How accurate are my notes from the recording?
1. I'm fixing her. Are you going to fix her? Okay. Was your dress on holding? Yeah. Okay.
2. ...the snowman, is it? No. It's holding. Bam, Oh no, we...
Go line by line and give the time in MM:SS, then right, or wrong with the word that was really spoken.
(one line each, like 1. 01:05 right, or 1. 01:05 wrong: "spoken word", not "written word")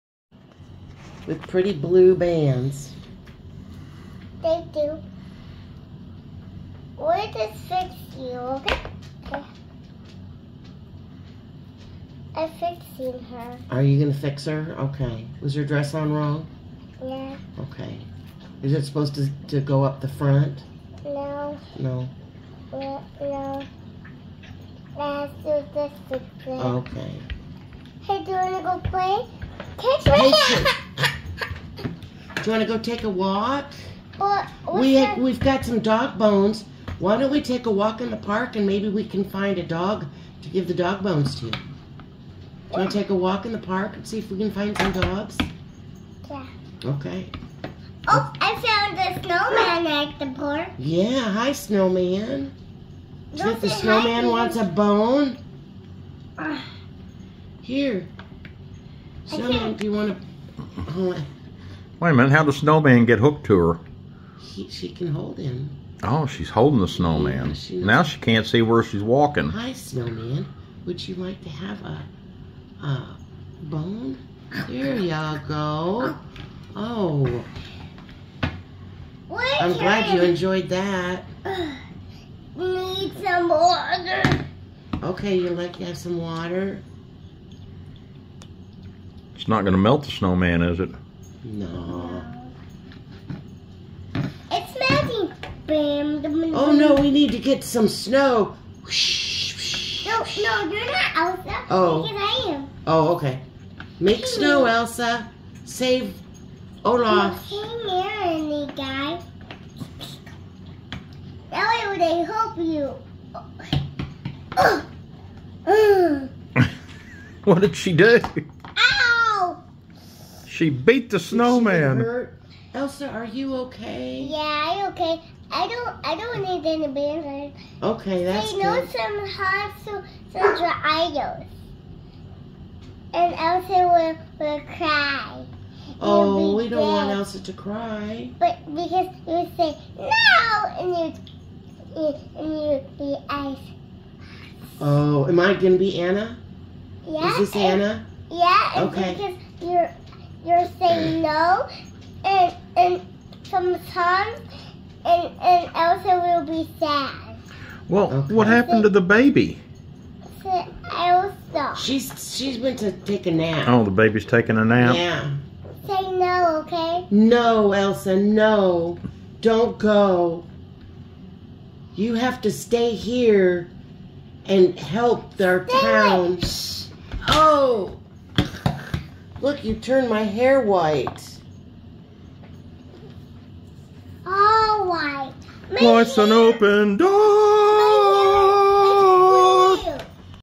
1. 00:12 wrong: "wrong", not "holding"
2. 01:30 wrong: "melting", not "holding".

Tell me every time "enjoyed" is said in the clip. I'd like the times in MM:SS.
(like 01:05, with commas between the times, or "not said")
01:20.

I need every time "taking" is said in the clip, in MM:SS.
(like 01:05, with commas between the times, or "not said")
02:44.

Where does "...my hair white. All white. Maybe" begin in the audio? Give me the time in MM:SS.
03:00.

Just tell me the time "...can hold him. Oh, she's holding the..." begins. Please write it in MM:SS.
01:04.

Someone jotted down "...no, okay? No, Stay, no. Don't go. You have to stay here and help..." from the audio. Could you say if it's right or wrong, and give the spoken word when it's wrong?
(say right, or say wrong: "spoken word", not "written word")
wrong: "Elsa", not "Stay".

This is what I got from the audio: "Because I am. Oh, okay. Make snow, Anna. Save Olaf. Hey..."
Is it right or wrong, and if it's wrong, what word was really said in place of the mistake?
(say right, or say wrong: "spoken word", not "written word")
wrong: "Elsa", not "Anna".